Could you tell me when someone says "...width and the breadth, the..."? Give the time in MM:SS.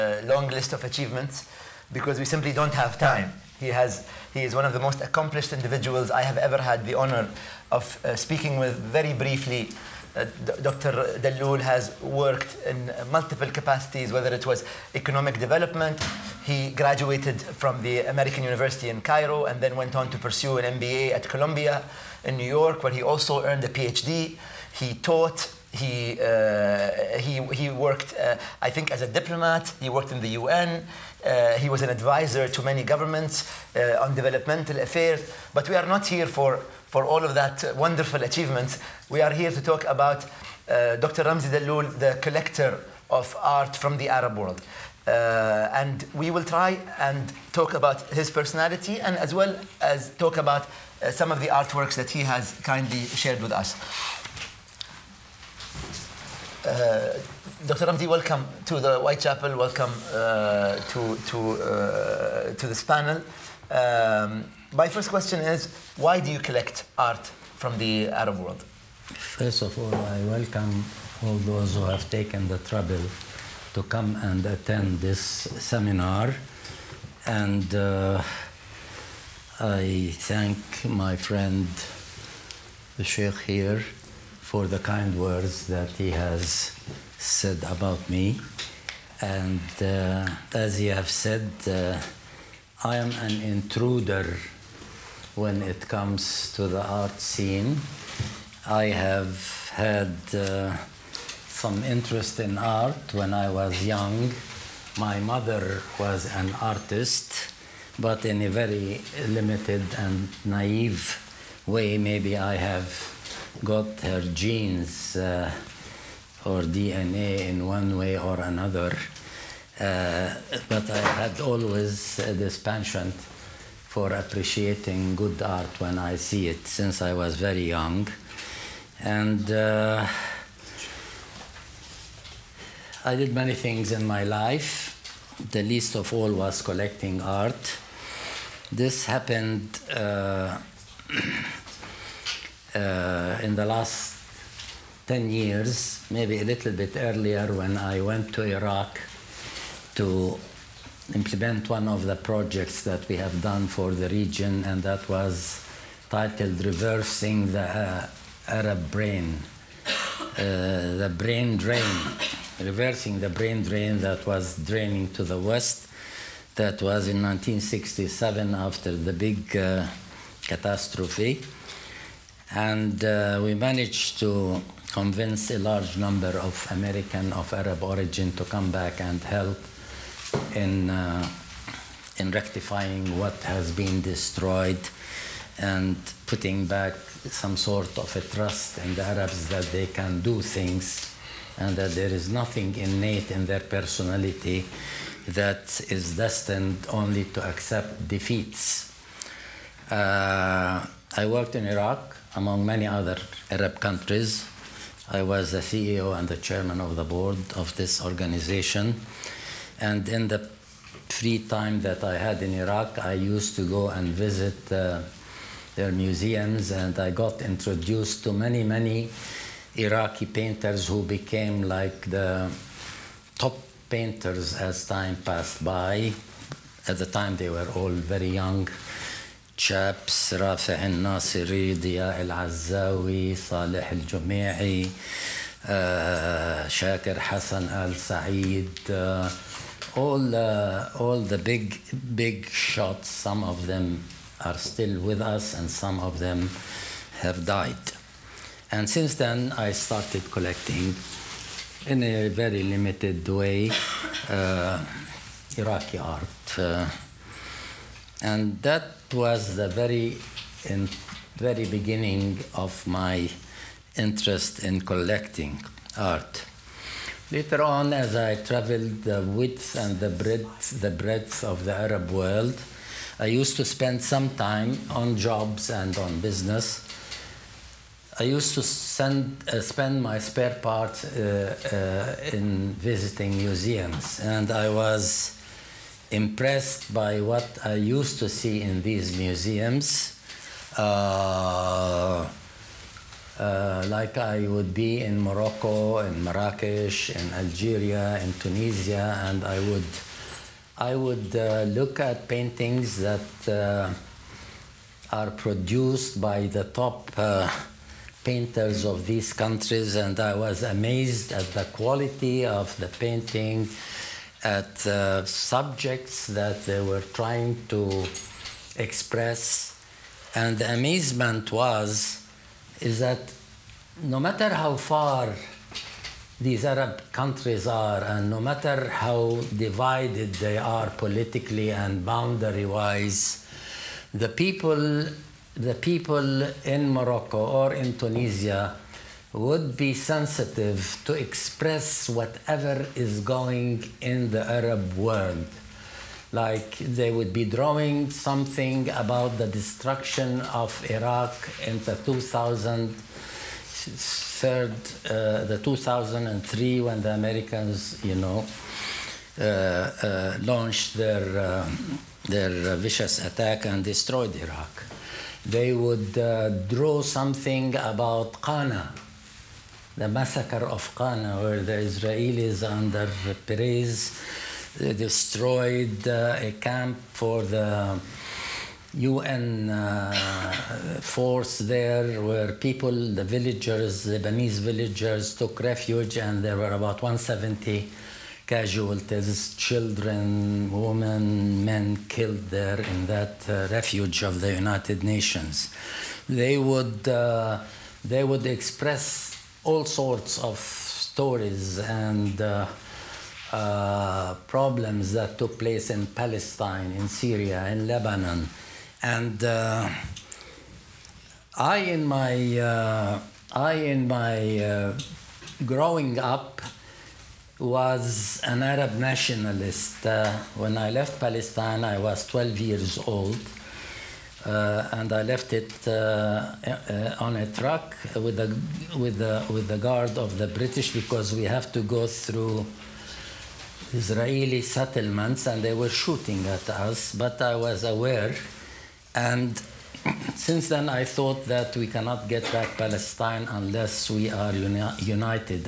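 04:29.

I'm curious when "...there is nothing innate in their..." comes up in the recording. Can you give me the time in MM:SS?
03:11.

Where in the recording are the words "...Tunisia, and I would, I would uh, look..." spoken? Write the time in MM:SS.
04:58.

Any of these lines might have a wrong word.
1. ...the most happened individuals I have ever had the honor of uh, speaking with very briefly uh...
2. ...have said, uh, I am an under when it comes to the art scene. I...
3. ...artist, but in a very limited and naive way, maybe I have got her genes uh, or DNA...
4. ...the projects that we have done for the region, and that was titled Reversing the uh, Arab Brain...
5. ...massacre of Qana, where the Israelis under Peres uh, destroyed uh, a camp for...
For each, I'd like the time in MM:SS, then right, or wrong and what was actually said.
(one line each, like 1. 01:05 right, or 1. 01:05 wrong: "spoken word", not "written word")
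1. 00:04 wrong: "accomplished", not "happened"
2. 01:30 wrong: "intruder", not "under"
3. 01:46 right
4. 02:32 right
5. 06:10 right.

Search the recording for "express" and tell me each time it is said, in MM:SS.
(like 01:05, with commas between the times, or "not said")
05:18, 05:41, 06:38.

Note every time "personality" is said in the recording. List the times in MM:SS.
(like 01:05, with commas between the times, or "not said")
00:48, 03:13.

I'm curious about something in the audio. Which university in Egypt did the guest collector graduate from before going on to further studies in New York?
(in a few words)
American University in Cairo.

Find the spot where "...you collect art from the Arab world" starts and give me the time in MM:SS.
01:06.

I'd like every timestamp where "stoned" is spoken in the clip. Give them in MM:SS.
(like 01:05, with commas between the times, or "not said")
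not said.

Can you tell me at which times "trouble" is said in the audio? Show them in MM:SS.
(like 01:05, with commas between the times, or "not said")
01:12.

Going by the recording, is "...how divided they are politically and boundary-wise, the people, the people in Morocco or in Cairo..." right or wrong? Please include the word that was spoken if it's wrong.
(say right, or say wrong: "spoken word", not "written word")
wrong: "Tunisia", not "Cairo".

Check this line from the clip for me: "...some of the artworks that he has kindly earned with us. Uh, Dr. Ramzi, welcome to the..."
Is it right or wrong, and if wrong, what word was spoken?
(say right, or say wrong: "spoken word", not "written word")
wrong: "shared", not "earned".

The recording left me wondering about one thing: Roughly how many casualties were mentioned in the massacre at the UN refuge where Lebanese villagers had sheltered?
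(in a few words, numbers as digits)
About 170.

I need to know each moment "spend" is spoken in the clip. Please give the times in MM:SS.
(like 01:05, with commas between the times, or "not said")
04:33, 04:39.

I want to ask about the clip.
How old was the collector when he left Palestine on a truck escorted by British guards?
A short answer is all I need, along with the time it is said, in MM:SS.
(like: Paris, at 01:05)
12, at 07:02.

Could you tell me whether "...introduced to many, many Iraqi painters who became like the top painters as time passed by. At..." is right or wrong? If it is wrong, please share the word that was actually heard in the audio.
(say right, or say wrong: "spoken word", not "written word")
right.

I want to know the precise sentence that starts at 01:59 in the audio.
Uh, but I had always uh, this penchant for appreciating good art when I see it since I was very young.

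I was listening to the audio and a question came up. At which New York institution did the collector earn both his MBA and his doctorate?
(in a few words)
Columbia.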